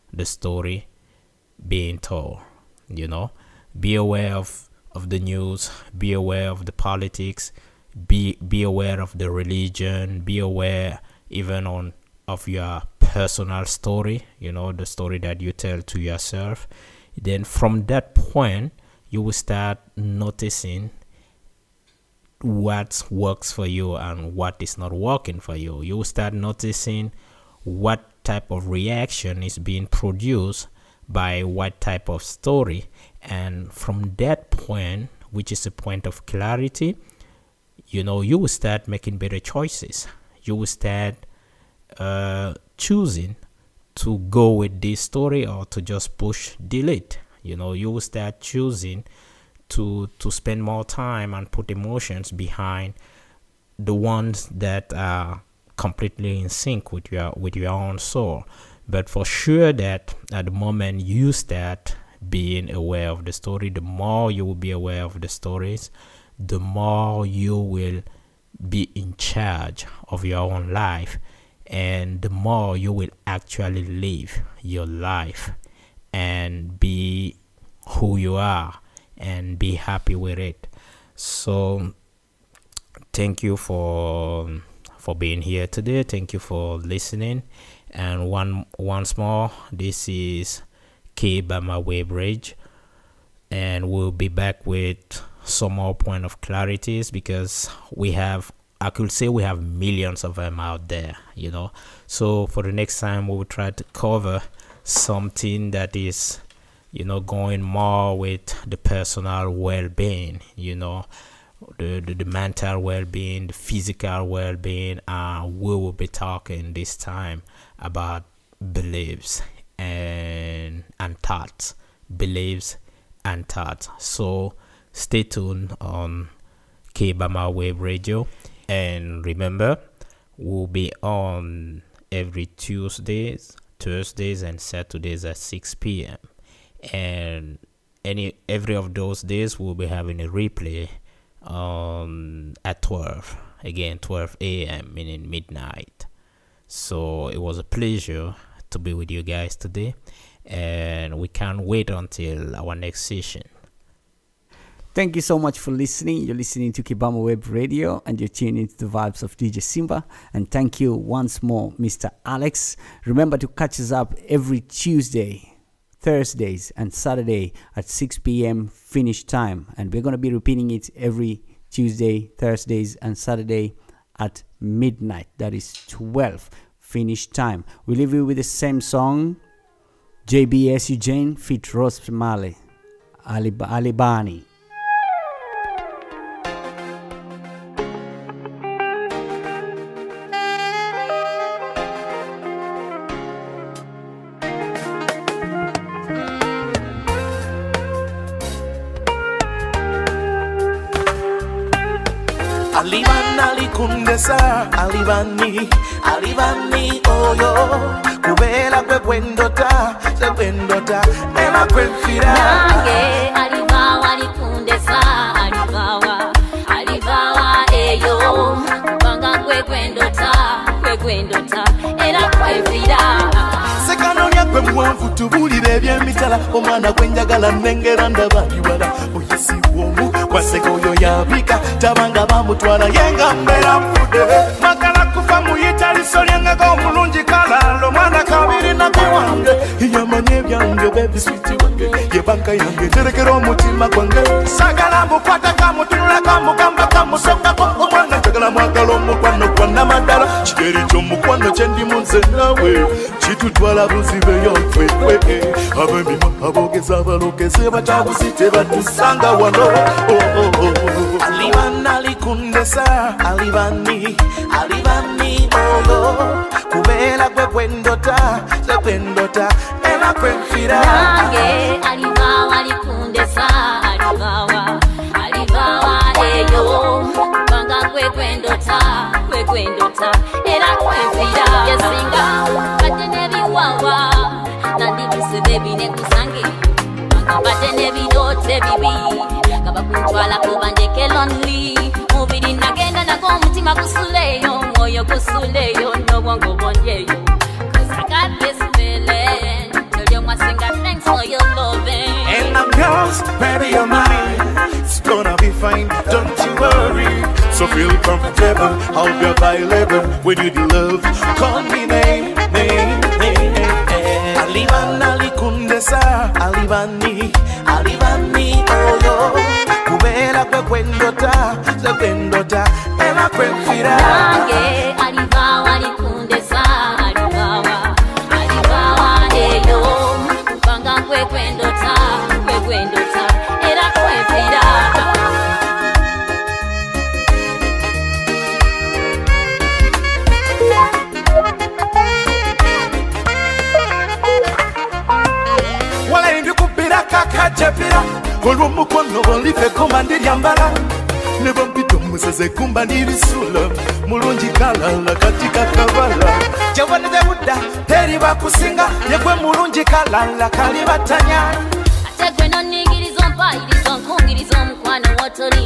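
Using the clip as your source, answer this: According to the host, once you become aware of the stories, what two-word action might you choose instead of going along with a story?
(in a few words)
push delete.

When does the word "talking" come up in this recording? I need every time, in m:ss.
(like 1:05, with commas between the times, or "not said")
1:56.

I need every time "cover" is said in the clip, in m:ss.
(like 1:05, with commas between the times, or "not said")
1:43.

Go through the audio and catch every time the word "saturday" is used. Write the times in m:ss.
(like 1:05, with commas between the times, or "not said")
2:14, 2:46, 2:53.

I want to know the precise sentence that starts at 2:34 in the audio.
Thank you so much for listening.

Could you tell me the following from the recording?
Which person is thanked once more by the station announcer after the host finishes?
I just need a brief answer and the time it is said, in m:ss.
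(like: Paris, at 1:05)
Mr. Alex, at 2:41.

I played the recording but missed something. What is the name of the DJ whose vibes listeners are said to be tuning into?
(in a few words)
DJ Simba.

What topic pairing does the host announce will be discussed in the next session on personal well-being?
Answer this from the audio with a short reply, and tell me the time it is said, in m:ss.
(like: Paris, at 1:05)
beliefs and thoughts, at 2:02.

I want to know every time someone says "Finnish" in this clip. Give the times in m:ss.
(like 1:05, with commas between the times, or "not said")
2:48, 2:56.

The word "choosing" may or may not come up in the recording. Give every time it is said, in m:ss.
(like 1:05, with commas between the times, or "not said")
0:42, 0:48.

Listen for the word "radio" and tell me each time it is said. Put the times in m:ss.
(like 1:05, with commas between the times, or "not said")
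2:07, 2:37.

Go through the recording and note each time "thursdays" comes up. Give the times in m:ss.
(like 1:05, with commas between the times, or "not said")
2:13, 2:46, 2:52.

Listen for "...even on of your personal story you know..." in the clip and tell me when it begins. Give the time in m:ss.
0:11.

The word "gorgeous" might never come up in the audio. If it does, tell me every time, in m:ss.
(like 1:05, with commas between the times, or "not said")
not said.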